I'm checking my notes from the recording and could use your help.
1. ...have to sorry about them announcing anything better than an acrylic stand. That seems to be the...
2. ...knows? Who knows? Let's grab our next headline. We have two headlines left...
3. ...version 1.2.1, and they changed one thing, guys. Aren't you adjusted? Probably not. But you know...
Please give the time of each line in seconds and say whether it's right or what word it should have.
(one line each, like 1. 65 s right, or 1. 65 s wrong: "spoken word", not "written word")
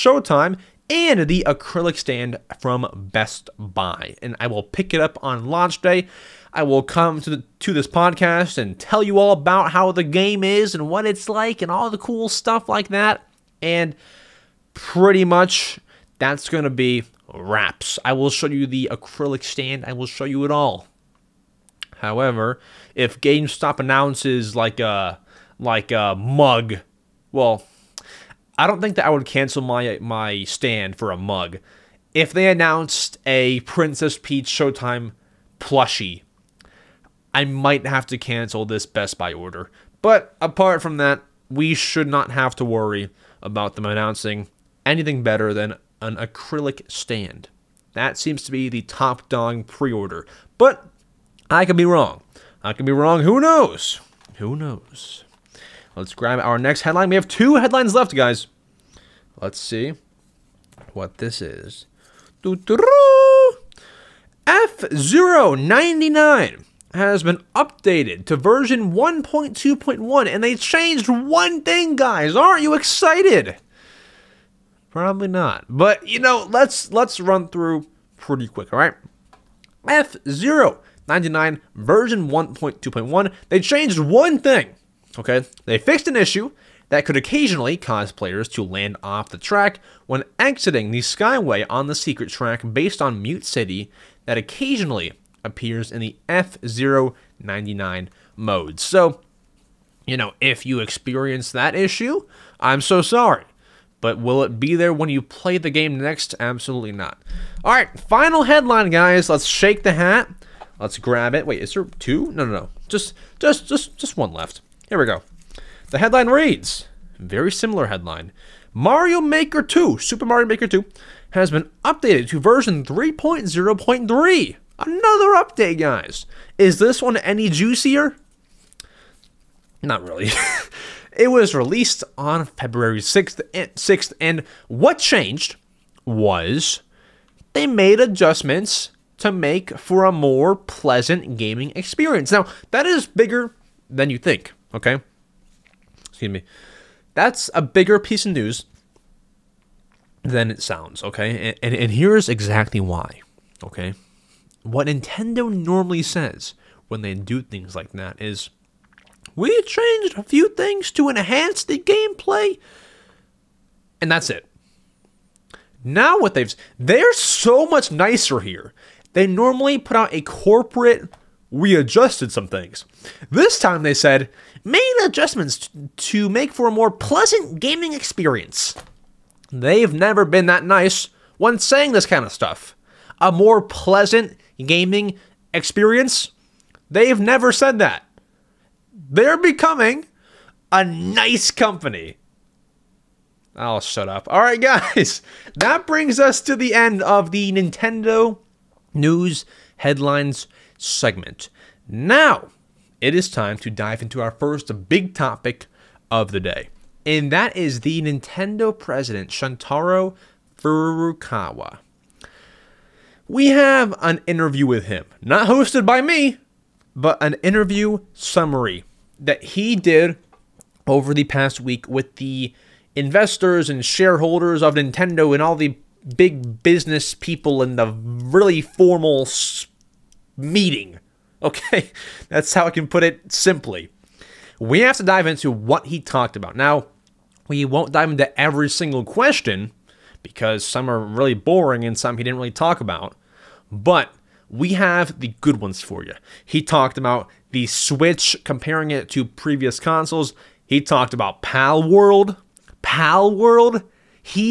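1. 42 s wrong: "worry", not "sorry"
2. 53 s right
3. 68 s wrong: "excited", not "adjusted".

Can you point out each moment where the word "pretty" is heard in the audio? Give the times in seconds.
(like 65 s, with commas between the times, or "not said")
14 s, 78 s.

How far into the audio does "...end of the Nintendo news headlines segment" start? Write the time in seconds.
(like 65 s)
196 s.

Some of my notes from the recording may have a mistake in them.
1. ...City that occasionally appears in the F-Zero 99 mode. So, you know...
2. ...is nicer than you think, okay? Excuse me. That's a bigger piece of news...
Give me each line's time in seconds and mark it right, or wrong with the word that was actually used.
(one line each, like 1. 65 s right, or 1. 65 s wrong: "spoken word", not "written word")
1. 93 s right
2. 142 s wrong: "bigger", not "nicer".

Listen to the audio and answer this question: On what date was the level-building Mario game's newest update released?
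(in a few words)
February 6.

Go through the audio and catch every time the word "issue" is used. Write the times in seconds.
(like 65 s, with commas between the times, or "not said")
86 s, 101 s.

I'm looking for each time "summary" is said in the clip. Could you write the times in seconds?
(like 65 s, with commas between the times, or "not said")
218 s.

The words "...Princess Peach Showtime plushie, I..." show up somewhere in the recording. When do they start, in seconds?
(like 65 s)
33 s.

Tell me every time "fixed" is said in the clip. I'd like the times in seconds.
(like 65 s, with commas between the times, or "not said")
85 s.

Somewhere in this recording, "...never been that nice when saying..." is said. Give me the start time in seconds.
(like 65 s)
179 s.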